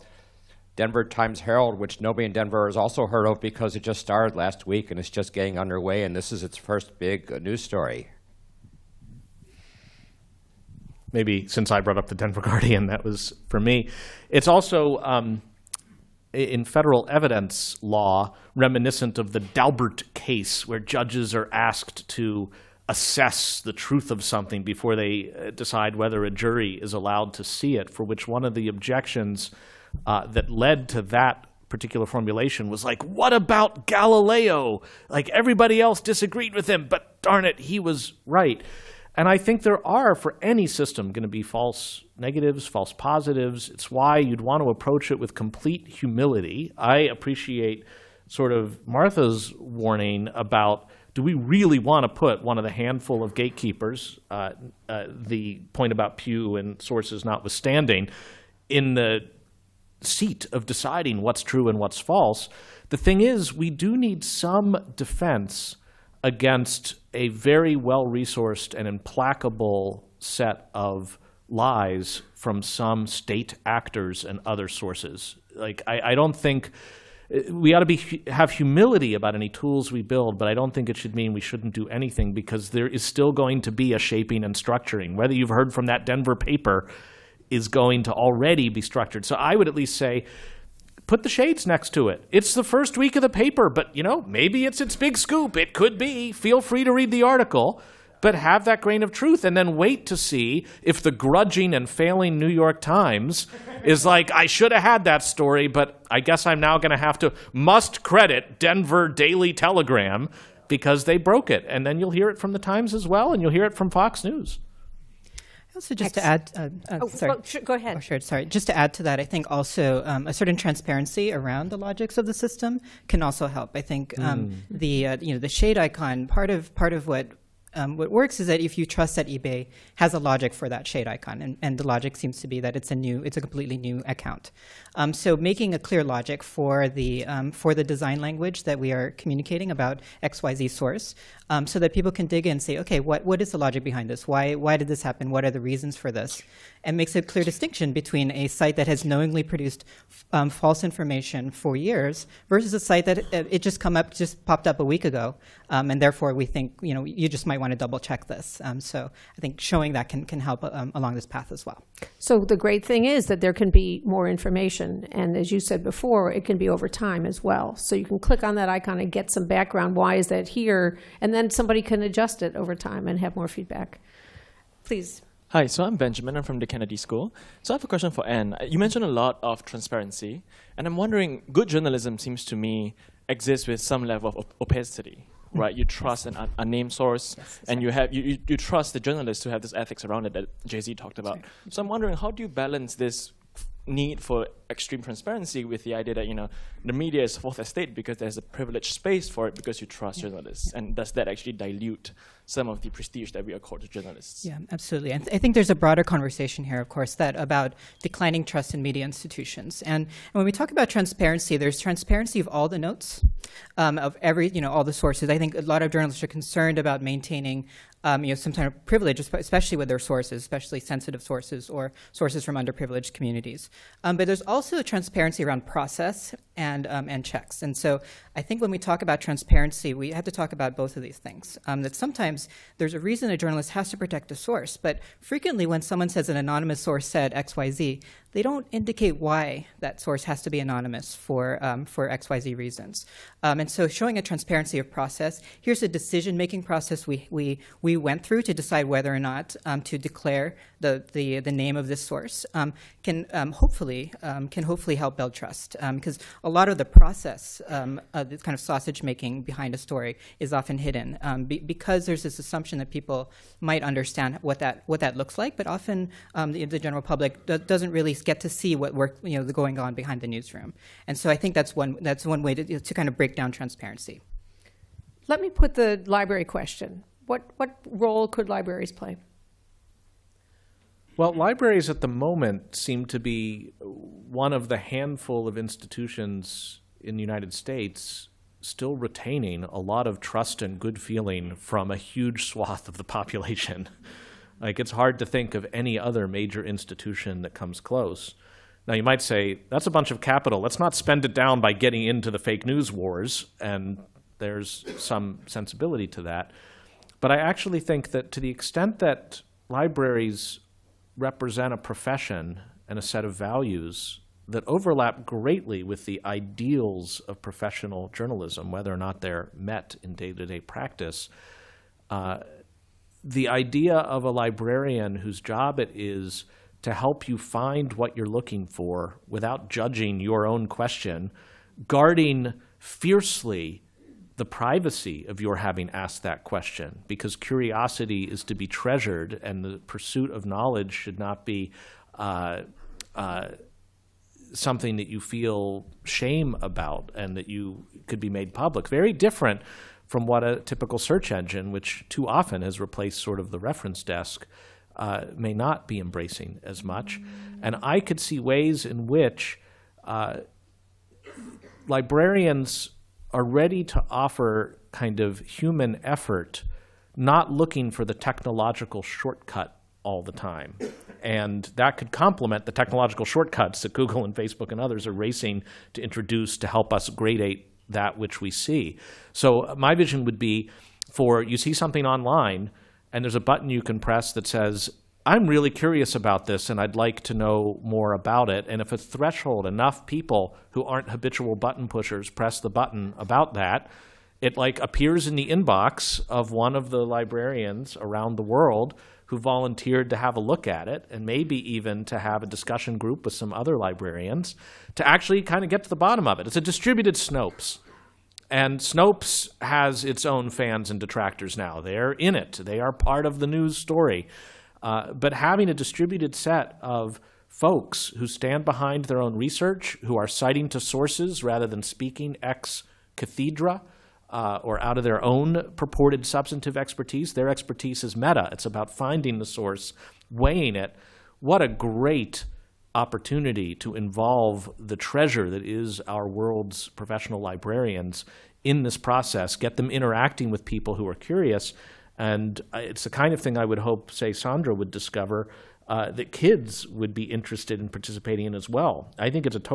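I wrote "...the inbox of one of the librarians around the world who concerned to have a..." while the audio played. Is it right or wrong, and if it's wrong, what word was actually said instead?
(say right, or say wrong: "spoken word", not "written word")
wrong: "volunteered", not "concerned".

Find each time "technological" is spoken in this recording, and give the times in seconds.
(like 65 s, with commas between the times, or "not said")
368 s, 372 s.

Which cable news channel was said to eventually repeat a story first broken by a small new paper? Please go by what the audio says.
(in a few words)
Fox News.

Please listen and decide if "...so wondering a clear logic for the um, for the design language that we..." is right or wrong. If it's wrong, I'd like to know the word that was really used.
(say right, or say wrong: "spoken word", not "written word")
wrong: "making", not "wondering".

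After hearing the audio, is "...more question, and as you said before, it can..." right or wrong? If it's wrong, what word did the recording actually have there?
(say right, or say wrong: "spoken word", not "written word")
wrong: "information", not "question".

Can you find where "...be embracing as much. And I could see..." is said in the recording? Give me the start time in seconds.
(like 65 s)
355 s.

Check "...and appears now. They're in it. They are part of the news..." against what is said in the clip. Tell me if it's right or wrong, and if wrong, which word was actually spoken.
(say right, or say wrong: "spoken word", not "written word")
wrong: "detractors", not "appears".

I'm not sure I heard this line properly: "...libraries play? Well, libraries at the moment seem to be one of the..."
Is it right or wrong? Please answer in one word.
right.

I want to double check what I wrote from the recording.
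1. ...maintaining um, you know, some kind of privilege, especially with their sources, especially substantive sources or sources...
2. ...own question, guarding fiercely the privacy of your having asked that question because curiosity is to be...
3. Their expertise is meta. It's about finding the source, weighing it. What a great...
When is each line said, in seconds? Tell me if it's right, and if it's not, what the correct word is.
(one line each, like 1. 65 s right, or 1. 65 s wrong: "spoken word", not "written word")
1. 217 s wrong: "sensitive", not "substantive"
2. 330 s right
3. 427 s right.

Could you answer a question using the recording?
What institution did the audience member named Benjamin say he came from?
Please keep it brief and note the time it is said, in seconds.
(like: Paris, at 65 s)
Kennedy School, at 176 s.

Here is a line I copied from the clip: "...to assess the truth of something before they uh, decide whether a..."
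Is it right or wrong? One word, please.
right.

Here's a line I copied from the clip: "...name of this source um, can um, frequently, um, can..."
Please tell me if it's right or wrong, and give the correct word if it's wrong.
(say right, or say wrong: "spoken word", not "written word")
wrong: "hopefully", not "frequently".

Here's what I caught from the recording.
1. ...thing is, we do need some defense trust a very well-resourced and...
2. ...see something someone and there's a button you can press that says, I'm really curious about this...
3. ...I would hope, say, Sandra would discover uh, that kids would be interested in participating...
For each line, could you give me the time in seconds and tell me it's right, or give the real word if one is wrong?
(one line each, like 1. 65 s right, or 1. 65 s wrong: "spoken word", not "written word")
1. 62 s wrong: "against", not "trust"
2. 381 s wrong: "online", not "someone"
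3. 443 s right.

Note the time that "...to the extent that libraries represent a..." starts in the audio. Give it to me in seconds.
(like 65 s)
308 s.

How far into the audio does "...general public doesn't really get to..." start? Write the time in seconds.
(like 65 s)
266 s.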